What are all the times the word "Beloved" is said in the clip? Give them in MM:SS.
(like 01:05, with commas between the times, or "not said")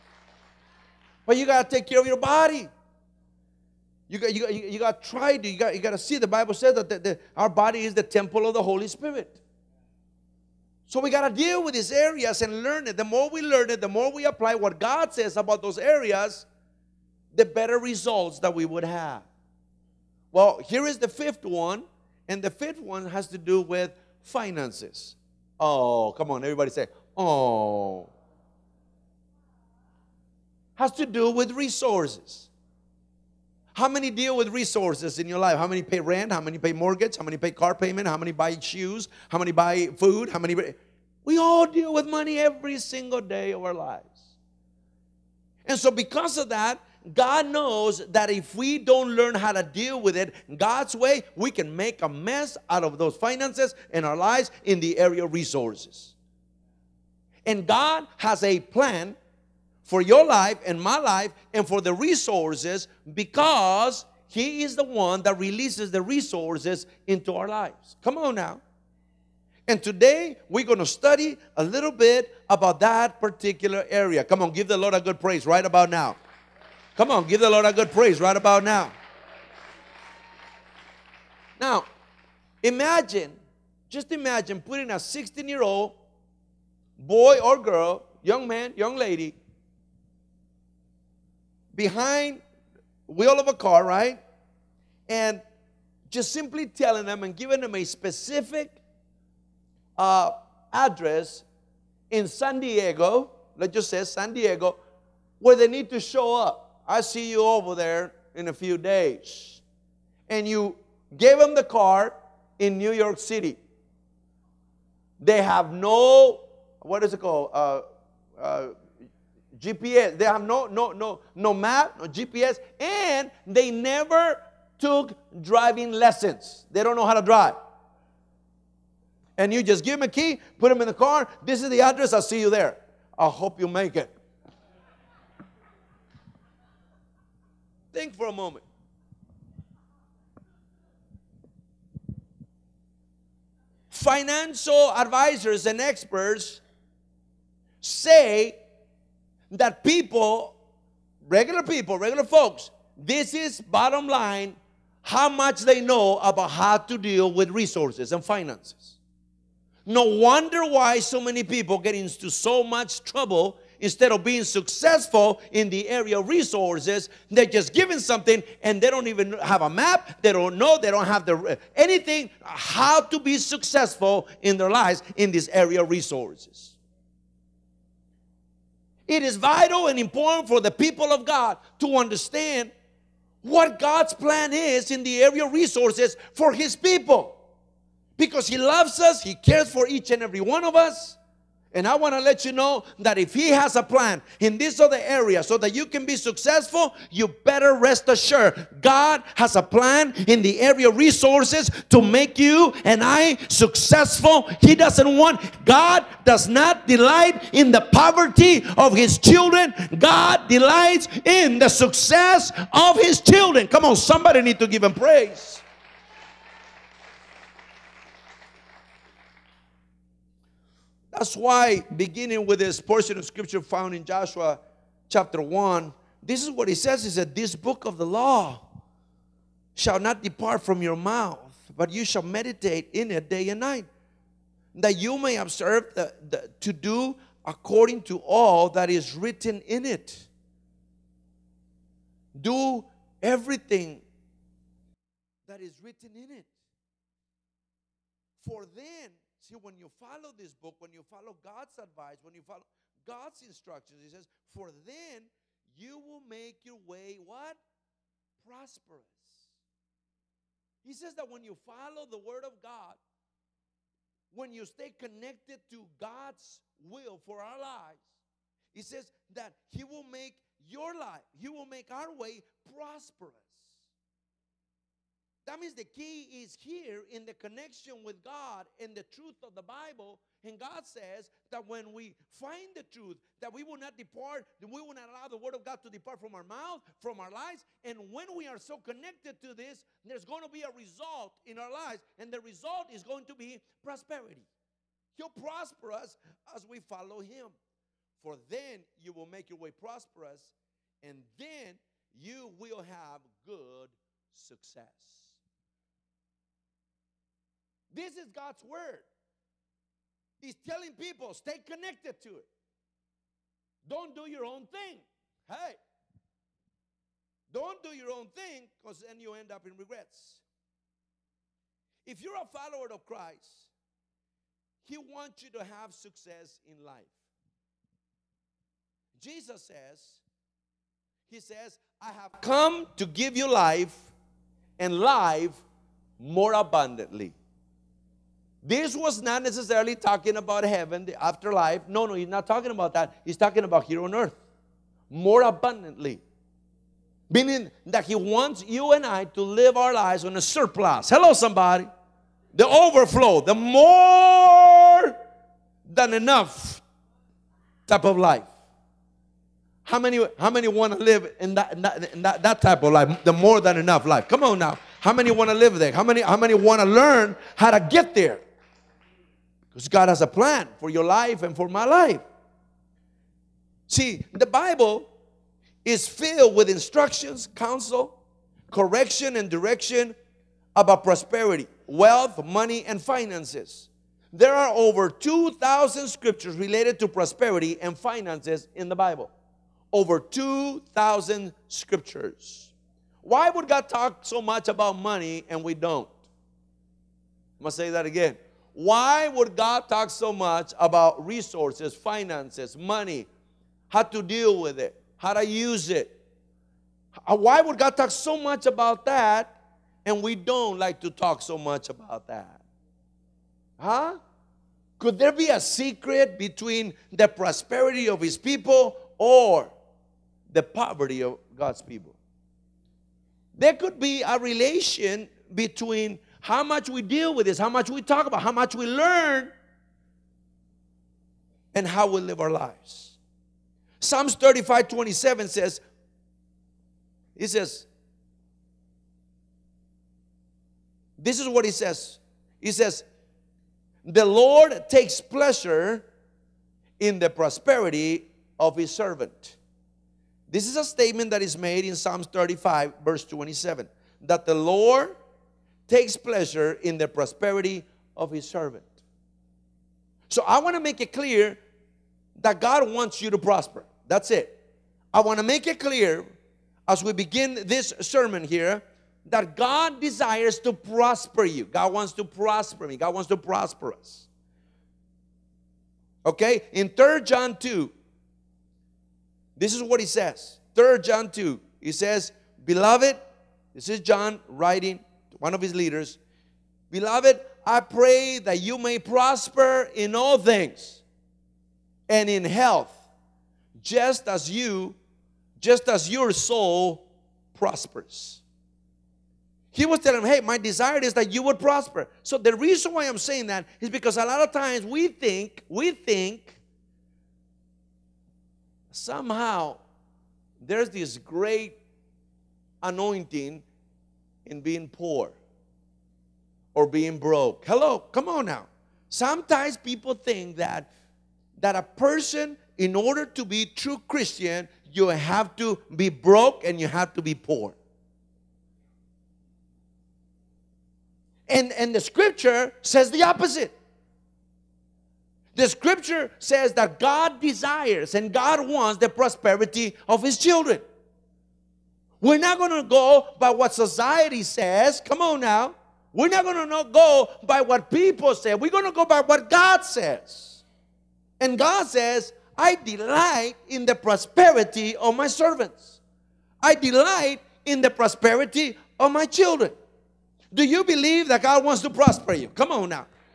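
08:02, 08:06.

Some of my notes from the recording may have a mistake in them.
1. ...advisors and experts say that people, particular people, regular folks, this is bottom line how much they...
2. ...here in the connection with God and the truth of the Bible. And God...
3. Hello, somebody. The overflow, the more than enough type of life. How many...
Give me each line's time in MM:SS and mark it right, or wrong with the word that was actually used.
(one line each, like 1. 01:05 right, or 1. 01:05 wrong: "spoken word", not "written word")
1. 02:24 wrong: "regular", not "particular"
2. 04:36 right
3. 05:51 right.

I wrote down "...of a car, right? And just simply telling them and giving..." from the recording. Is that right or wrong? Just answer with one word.
right.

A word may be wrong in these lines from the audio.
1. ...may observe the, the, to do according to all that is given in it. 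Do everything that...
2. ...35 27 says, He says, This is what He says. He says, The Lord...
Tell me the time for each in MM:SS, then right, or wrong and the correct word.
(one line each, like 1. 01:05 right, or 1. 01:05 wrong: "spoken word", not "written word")
1. 03:55 wrong: "written", not "given"
2. 07:14 right.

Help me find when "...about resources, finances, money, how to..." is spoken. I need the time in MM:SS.
06:40.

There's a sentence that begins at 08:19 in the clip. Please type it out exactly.
He was telling him, Hey, my desire is that you would prosper.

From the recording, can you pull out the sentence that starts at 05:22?
If you're a follower of Christ, He wants you to have success in life.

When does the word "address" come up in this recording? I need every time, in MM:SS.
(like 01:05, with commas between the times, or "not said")
01:40, 02:11.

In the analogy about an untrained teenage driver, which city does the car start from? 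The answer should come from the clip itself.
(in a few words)
New York City.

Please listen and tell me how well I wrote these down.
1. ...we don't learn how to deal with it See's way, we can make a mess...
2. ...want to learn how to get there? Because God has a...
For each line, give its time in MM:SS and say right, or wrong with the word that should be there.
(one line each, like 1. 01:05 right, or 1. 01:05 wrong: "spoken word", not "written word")
1. 00:48 wrong: "God", not "See"
2. 06:06 right.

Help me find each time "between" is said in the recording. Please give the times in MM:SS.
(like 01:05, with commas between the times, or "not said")
06:56, 07:05.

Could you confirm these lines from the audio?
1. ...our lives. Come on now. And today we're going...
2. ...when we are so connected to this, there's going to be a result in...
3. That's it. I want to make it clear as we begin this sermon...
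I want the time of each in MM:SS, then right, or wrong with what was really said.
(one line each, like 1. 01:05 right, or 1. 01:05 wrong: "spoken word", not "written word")
1. 01:07 right
2. 04:48 right
3. 07:44 right.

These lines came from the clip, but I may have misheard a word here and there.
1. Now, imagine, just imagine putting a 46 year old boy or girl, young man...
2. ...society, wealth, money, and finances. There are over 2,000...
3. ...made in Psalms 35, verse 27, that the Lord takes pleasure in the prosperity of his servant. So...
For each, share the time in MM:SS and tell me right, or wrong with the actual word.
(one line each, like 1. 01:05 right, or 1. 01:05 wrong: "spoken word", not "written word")
1. 01:21 wrong: "16", not "46"
2. 06:21 wrong: "prosperity", not "society"
3. 07:31 right.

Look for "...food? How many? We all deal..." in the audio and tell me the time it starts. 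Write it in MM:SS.
00:39.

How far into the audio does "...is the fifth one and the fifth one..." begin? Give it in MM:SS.
00:20.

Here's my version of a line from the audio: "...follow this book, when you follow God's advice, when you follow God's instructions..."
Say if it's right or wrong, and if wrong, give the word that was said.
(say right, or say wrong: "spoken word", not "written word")
right.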